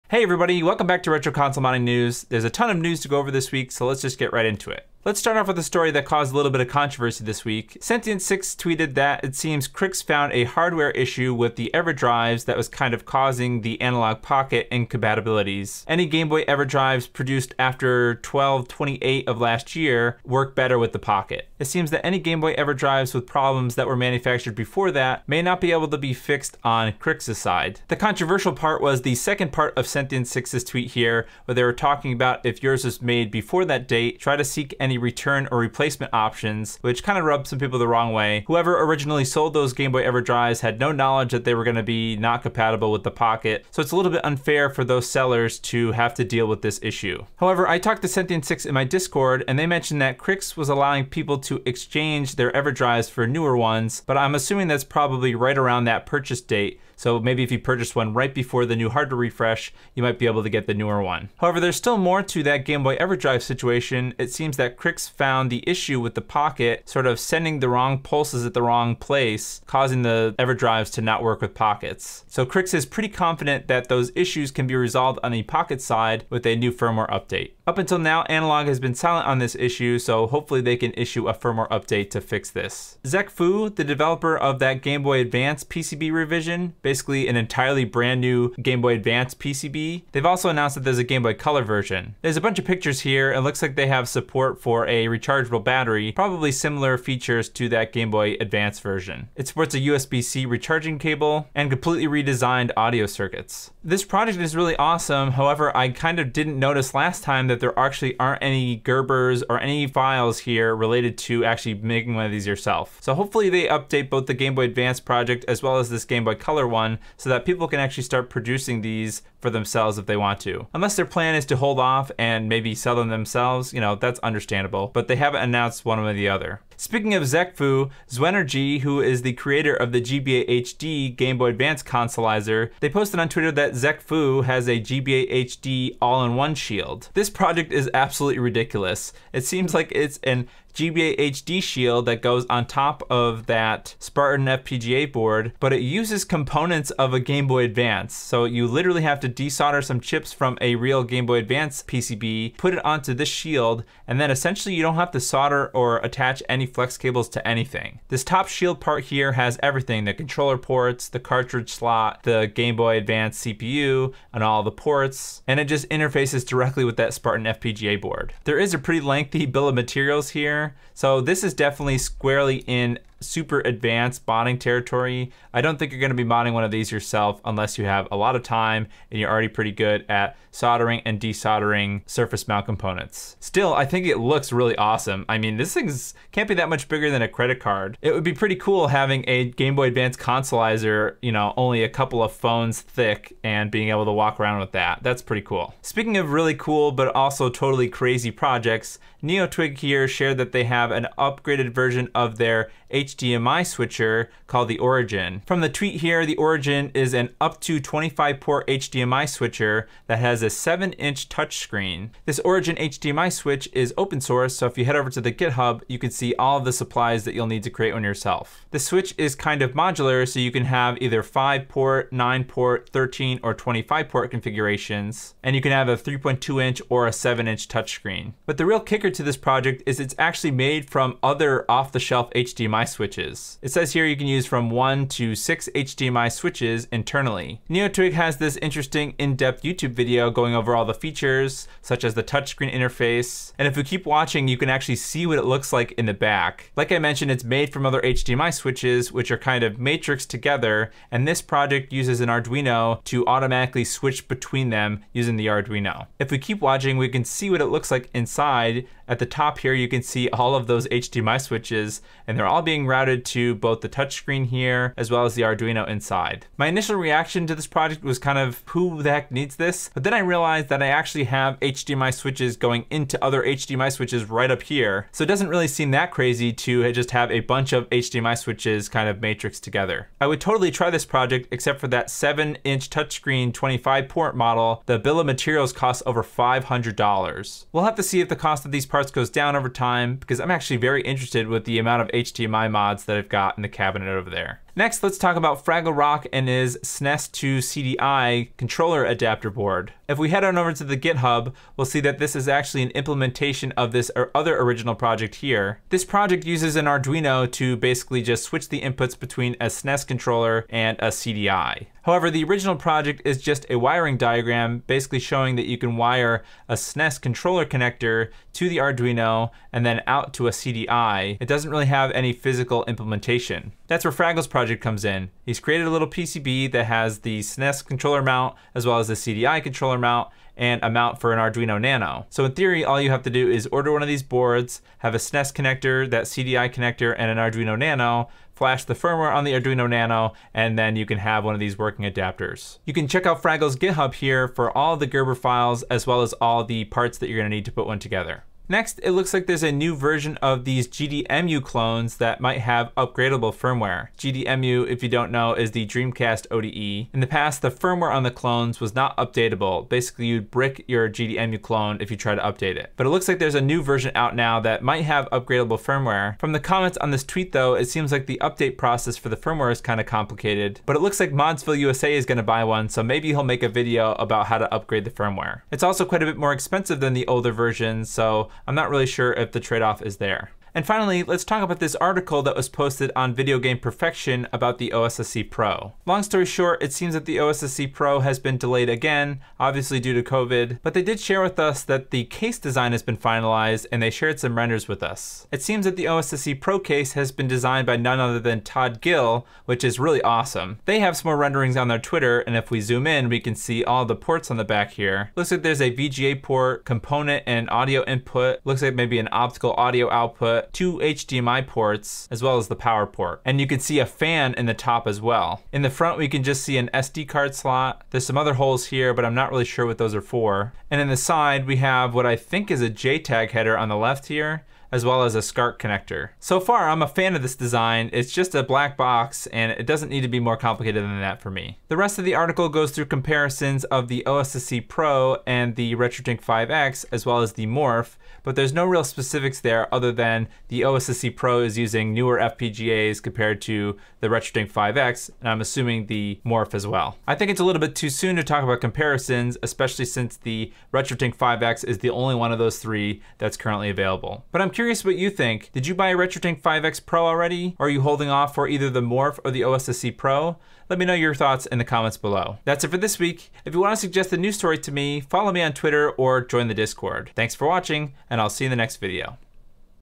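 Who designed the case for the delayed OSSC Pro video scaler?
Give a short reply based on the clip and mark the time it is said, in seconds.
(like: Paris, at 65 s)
Todd Gill, at 398 s.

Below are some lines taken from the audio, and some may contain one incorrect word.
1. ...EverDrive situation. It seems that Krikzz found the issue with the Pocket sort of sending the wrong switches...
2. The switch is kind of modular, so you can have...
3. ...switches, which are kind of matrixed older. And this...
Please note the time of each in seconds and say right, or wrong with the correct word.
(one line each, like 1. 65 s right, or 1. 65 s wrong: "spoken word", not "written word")
1. 62 s wrong: "pulses", not "switches"
2. 218 s right
3. 248 s wrong: "together", not "older".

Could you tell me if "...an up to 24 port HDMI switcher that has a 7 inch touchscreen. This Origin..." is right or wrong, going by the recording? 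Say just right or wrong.
wrong.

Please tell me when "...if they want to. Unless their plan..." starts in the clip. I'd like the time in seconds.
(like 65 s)
119 s.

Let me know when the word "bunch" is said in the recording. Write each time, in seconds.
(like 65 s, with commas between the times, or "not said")
92 s, 277 s.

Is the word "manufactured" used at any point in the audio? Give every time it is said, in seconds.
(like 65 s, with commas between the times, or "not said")
23 s.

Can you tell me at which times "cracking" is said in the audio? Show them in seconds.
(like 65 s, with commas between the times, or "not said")
not said.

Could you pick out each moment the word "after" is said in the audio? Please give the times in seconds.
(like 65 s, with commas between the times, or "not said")
17 s.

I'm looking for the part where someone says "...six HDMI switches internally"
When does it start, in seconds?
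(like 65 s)
235 s.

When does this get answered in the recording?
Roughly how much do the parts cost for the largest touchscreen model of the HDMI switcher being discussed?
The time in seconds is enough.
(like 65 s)
286 s.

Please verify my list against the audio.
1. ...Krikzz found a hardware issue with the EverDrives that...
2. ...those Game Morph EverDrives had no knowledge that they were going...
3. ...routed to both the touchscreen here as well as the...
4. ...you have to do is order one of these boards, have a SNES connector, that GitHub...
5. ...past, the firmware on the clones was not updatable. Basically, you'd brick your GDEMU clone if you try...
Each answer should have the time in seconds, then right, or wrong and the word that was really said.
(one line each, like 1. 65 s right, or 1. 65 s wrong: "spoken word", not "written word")
1. 9 s right
2. 39 s wrong: "Boy", not "Morph"
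3. 262 s right
4. 332 s wrong: "CDI", not "GitHub"
5. 357 s right.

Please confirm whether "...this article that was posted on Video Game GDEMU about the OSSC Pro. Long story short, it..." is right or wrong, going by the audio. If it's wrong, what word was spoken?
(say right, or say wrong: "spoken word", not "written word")
wrong: "Perfection", not "GDEMU".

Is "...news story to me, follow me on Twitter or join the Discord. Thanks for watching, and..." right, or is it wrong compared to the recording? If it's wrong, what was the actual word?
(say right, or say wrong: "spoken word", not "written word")
right.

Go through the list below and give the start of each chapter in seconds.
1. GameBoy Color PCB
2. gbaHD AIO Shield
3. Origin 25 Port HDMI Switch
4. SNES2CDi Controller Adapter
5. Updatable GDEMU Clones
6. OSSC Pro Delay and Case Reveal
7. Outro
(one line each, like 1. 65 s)
1. 83 s
2. 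127 s
3. 196 s
4. 295 s
5. 348 s
6. 381 s
7. 462 s.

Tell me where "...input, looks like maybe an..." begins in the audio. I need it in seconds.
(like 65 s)
408 s.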